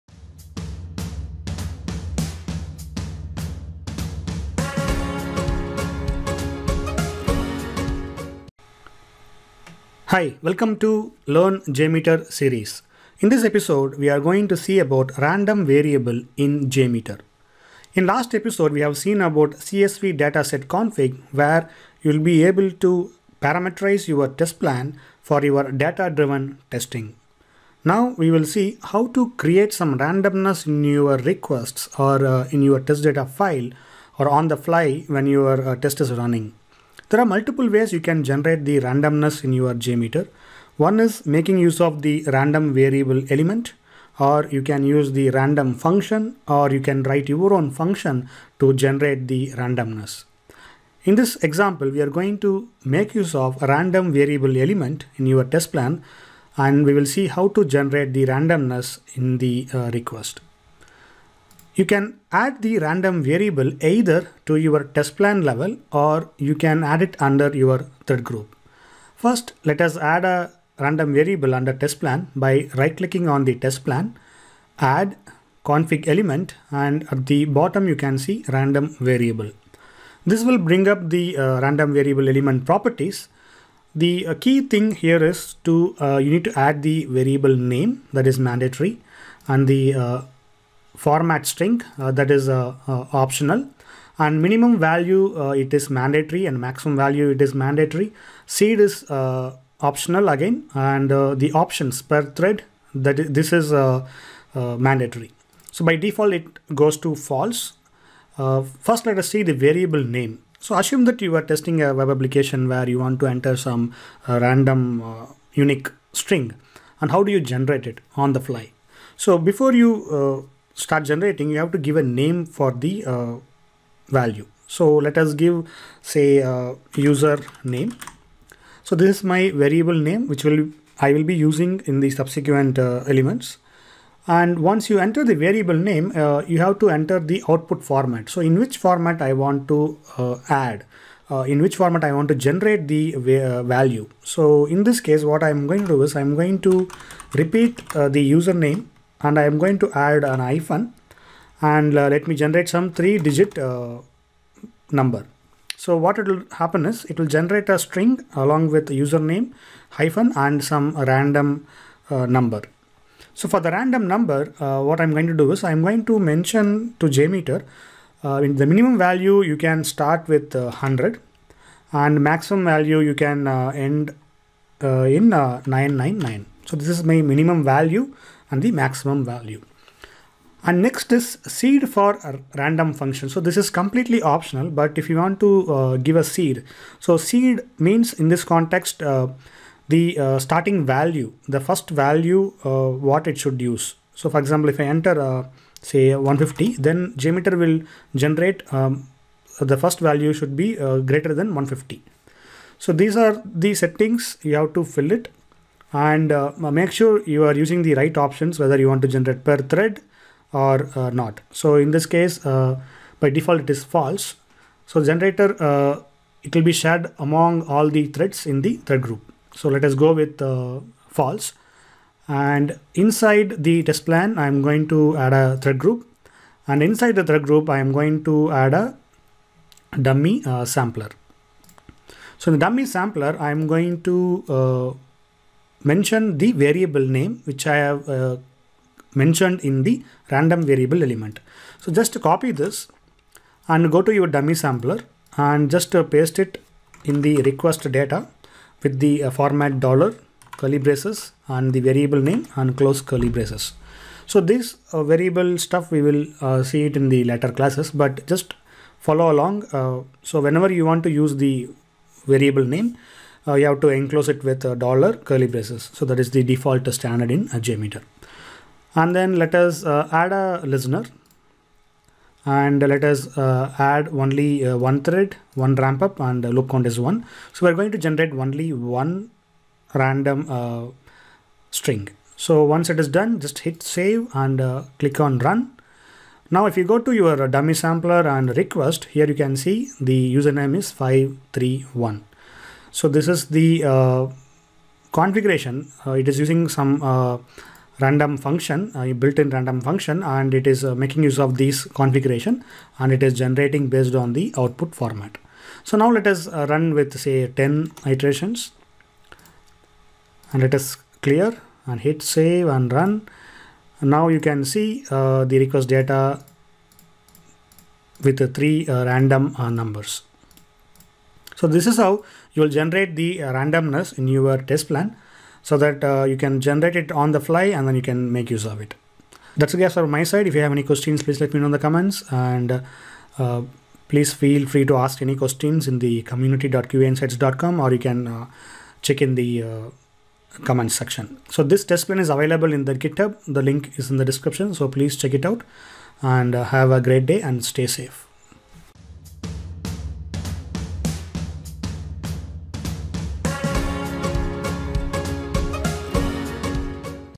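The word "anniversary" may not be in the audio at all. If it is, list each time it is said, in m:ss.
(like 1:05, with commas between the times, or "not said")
not said.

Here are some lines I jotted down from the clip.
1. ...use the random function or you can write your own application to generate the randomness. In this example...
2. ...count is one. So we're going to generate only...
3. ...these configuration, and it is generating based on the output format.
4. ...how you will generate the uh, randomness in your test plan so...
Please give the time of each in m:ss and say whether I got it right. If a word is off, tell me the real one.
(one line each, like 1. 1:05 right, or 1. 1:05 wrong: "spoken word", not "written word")
1. 0:44 wrong: "function", not "application"
2. 4:36 right
3. 5:01 right
4. 5:21 right.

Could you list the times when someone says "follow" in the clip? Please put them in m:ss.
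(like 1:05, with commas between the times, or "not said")
4:18.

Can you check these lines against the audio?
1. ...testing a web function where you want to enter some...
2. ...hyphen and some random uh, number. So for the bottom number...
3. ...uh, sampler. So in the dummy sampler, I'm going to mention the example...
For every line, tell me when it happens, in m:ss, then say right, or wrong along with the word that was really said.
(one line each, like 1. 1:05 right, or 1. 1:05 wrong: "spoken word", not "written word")
1. 1:51 wrong: "application", not "function"
2. 2:39 wrong: "random", not "bottom"
3. 3:50 wrong: "variable", not "example".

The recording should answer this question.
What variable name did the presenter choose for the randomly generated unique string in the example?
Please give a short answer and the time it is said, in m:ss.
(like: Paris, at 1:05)
user name, at 2:06.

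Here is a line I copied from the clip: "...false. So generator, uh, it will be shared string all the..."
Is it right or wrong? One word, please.
wrong.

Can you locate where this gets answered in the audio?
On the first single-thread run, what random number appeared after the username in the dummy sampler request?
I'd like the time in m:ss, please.
4:50.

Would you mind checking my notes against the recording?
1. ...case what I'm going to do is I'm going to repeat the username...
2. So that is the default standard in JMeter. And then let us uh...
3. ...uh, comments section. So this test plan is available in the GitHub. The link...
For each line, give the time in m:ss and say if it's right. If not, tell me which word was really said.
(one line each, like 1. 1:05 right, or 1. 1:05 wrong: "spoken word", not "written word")
1. 2:24 right
2. 4:25 right
3. 5:39 right.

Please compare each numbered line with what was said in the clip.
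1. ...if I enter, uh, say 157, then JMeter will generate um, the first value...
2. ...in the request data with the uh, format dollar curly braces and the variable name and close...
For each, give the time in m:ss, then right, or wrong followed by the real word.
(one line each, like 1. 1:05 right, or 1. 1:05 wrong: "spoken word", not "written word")
1. 3:14 wrong: "150", not "157"
2. 4:07 right.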